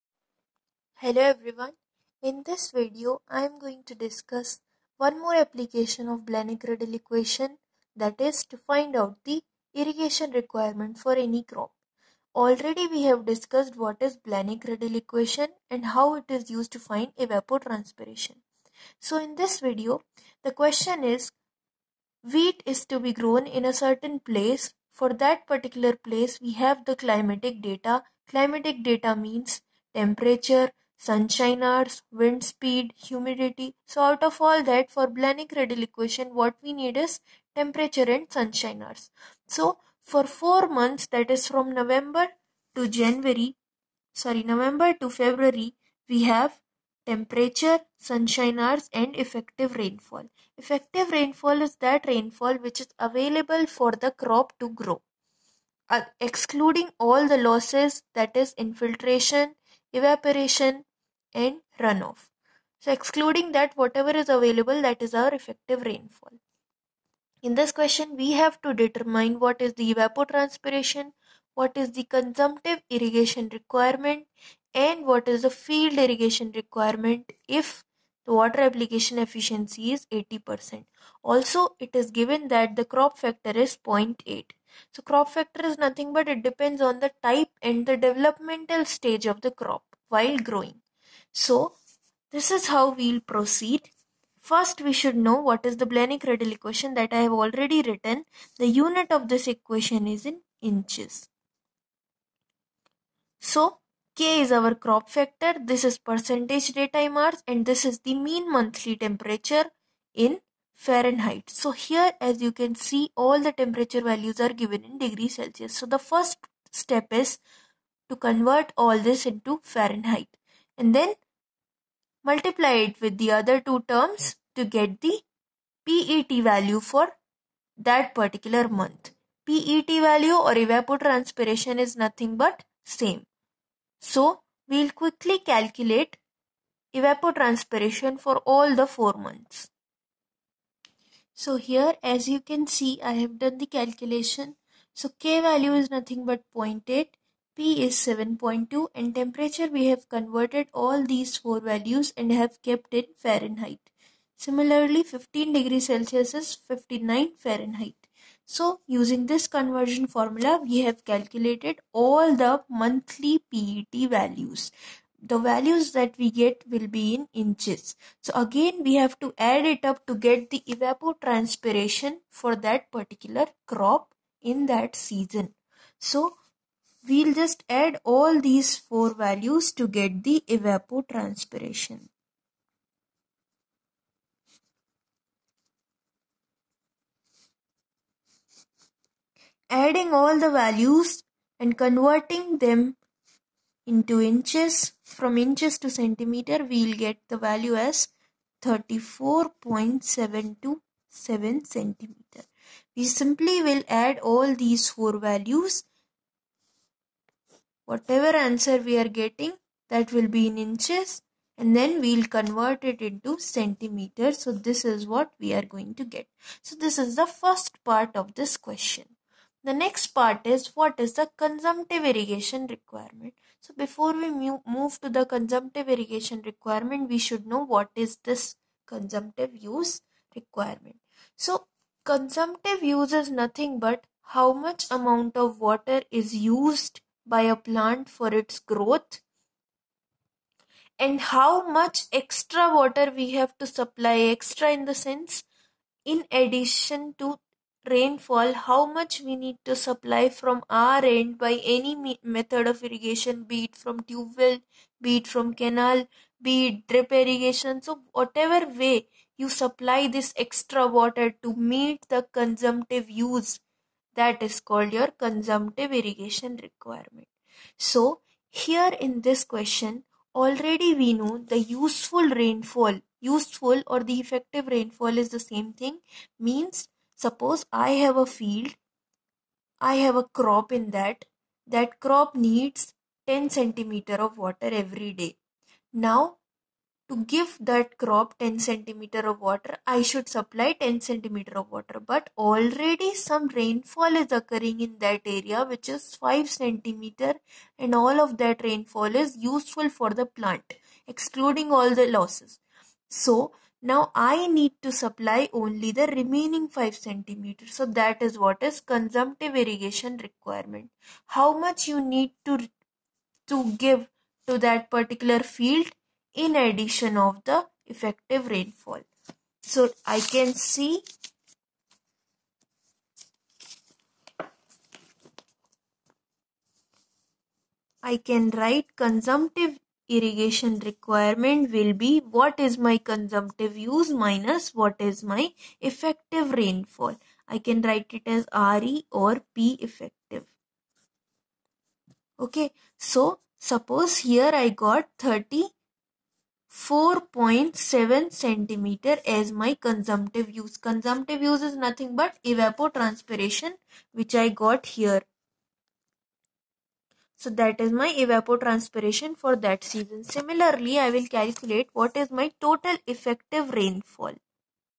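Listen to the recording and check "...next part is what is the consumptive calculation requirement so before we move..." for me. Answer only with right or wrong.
wrong.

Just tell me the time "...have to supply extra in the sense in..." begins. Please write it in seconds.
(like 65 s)
243 s.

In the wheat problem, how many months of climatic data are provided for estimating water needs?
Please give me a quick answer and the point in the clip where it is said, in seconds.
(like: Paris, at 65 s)
4, at 40 s.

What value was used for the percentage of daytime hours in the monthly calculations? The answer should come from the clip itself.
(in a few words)
7.2.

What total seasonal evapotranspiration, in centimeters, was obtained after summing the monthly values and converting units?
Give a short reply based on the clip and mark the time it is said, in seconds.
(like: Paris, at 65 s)
34.727 cm, at 198 s.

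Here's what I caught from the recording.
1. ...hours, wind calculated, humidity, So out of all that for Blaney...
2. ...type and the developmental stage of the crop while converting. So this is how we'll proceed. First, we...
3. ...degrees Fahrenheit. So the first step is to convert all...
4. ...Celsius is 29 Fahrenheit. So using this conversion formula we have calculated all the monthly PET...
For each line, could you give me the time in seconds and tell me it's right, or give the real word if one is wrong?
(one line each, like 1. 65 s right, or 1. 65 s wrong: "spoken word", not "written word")
1. 31 s wrong: "speed", not "calculated"
2. 87 s wrong: "growing", not "converting"
3. 114 s wrong: "Celsius", not "Fahrenheit"
4. 155 s wrong: "59", not "29".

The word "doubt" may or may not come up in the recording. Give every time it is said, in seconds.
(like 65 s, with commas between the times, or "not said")
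not said.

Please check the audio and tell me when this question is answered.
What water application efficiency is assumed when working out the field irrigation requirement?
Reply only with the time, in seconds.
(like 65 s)
80 s.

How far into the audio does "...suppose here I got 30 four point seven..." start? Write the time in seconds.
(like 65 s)
343 s.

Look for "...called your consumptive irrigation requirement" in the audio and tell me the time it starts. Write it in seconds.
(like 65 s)
264 s.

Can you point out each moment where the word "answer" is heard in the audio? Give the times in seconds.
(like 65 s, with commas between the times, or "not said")
208 s.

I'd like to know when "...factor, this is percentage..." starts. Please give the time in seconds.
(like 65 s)
105 s.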